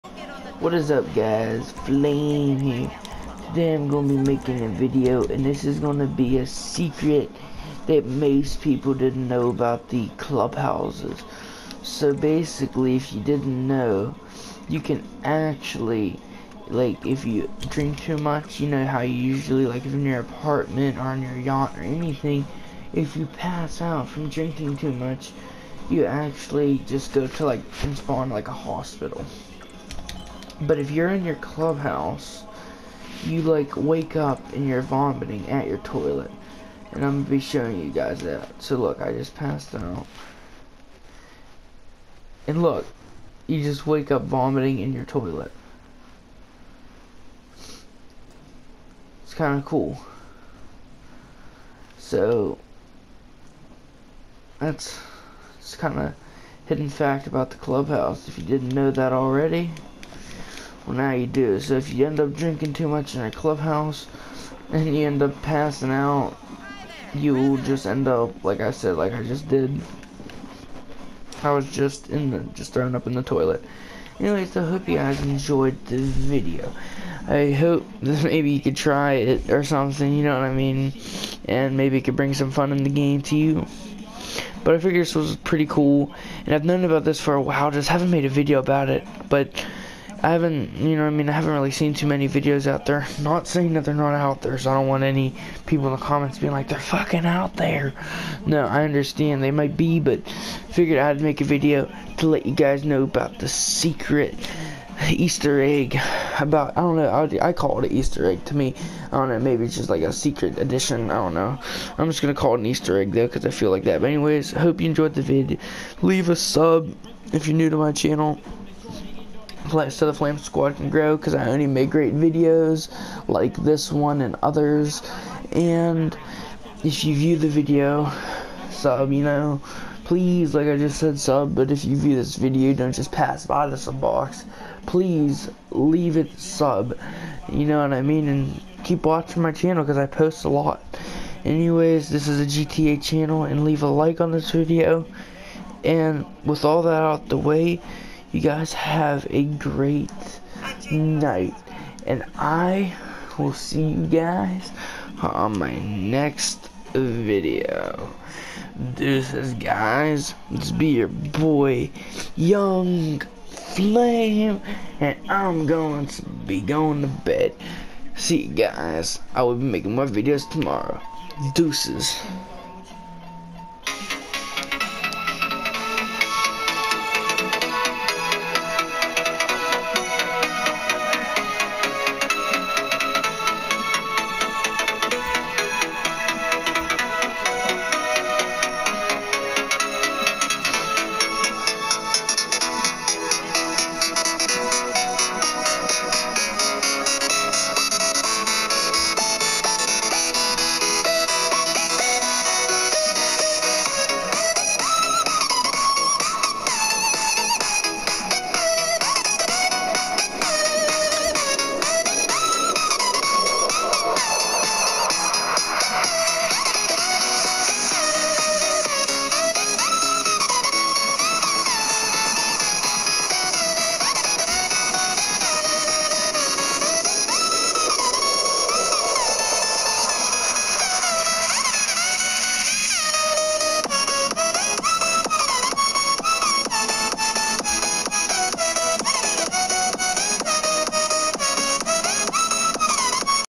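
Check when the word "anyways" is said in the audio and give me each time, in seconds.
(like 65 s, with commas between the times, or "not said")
74 s, 114 s, 141 s.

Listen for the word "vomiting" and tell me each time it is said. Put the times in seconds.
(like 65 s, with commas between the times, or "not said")
34 s, 44 s.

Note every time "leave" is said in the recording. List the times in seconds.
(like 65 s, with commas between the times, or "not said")
116 s, 135 s, 143 s.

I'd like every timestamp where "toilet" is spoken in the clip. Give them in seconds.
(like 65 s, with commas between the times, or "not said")
35 s, 45 s, 73 s.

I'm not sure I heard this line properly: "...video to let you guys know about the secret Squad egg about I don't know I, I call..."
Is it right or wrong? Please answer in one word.
wrong.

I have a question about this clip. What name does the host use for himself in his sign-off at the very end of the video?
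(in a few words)
Young Flame.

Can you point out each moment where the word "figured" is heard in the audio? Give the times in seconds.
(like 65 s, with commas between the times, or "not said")
84 s, 100 s.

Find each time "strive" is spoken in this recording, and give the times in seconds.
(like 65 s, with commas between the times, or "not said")
not said.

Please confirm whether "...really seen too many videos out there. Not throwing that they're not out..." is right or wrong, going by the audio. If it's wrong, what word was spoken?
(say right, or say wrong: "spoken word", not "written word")
wrong: "saying", not "throwing".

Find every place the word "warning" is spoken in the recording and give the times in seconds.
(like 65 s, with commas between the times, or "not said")
not said.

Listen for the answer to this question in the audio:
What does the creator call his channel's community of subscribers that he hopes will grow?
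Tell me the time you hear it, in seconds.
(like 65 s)
120 s.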